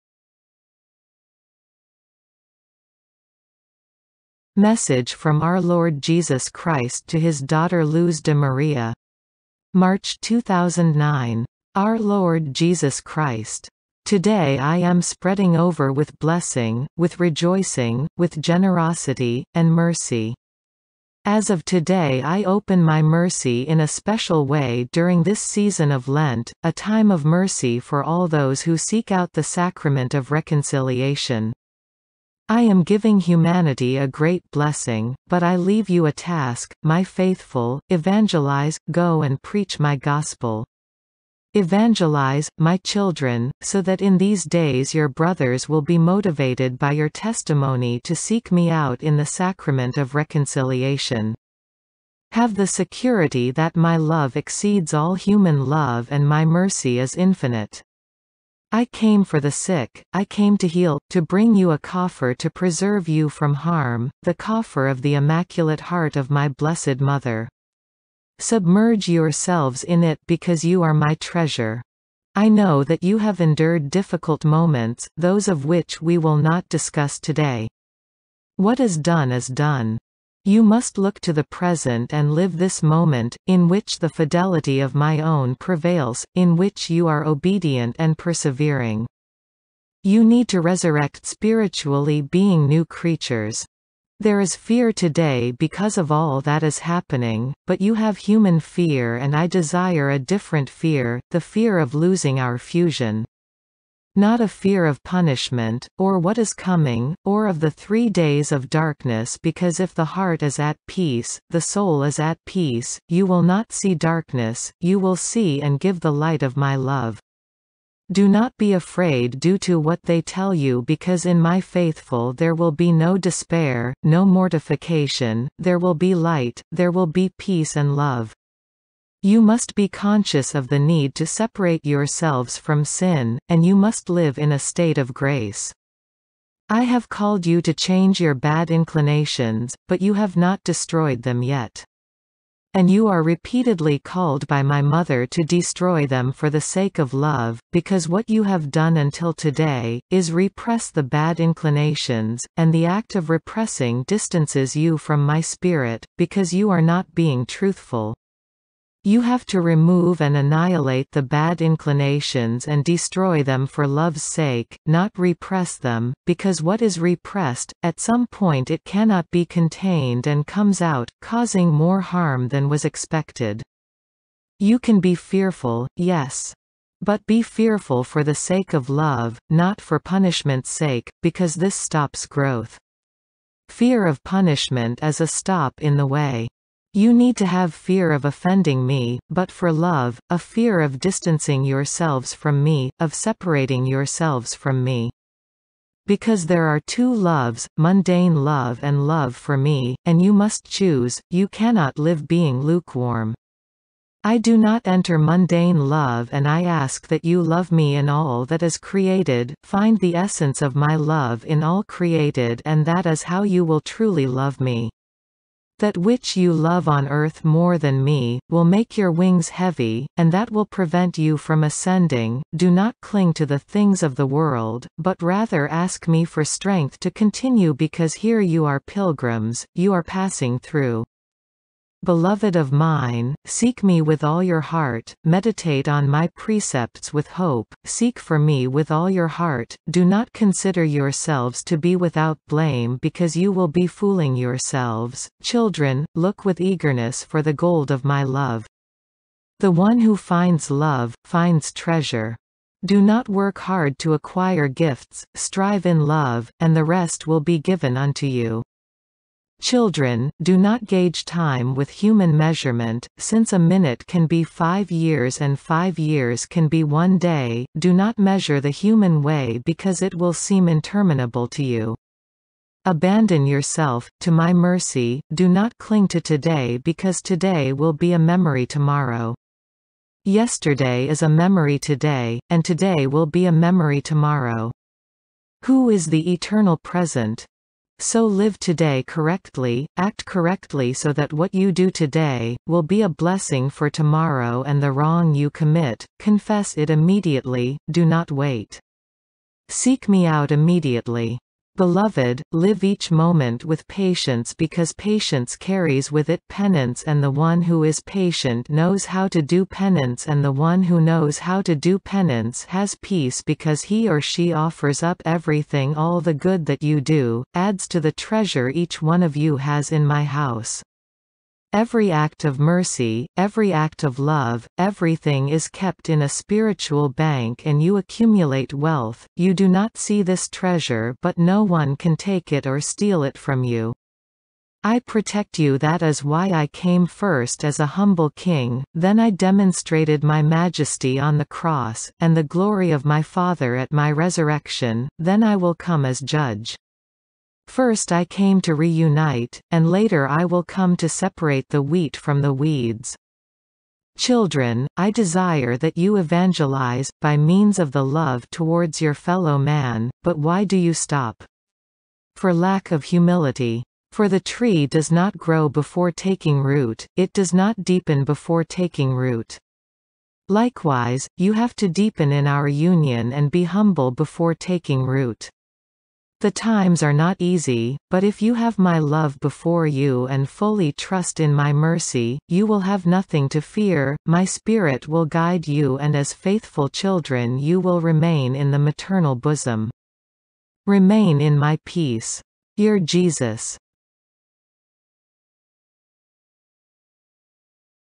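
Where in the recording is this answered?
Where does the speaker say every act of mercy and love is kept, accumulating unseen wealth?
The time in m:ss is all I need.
5:26.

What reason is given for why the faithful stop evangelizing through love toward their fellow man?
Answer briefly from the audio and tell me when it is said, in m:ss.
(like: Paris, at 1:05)
lack of humility, at 6:02.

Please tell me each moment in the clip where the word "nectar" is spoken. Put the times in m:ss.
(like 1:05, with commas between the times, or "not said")
not said.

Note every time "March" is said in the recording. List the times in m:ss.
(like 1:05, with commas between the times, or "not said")
0:09.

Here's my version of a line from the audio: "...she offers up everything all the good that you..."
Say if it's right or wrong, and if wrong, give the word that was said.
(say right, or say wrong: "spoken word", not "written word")
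right.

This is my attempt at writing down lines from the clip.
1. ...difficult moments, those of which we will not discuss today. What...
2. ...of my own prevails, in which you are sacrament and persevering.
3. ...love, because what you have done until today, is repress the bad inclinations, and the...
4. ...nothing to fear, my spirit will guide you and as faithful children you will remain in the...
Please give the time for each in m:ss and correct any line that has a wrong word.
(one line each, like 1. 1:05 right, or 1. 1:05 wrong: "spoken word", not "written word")
1. 1:13 right
2. 1:24 wrong: "obedient", not "sacrament"
3. 2:27 right
4. 6:23 right.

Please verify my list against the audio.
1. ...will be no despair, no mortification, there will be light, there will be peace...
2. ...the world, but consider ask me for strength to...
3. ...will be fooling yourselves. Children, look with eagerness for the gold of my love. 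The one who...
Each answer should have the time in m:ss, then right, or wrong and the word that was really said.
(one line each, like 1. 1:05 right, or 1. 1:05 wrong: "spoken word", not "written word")
1. 2:02 right
2. 3:44 wrong: "rather", not "consider"
3. 4:03 right.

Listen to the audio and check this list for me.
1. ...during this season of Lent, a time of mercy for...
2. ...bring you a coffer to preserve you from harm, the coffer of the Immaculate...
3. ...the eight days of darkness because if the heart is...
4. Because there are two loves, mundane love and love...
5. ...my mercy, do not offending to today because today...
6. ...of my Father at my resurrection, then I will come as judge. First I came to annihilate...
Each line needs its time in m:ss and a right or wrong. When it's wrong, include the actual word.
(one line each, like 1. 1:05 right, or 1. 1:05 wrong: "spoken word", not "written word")
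1. 0:24 right
2. 1:01 right
3. 1:47 wrong: "three", not "eight"
4. 3:16 right
5. 4:34 wrong: "cling", not "offending"
6. 5:42 wrong: "reunite", not "annihilate".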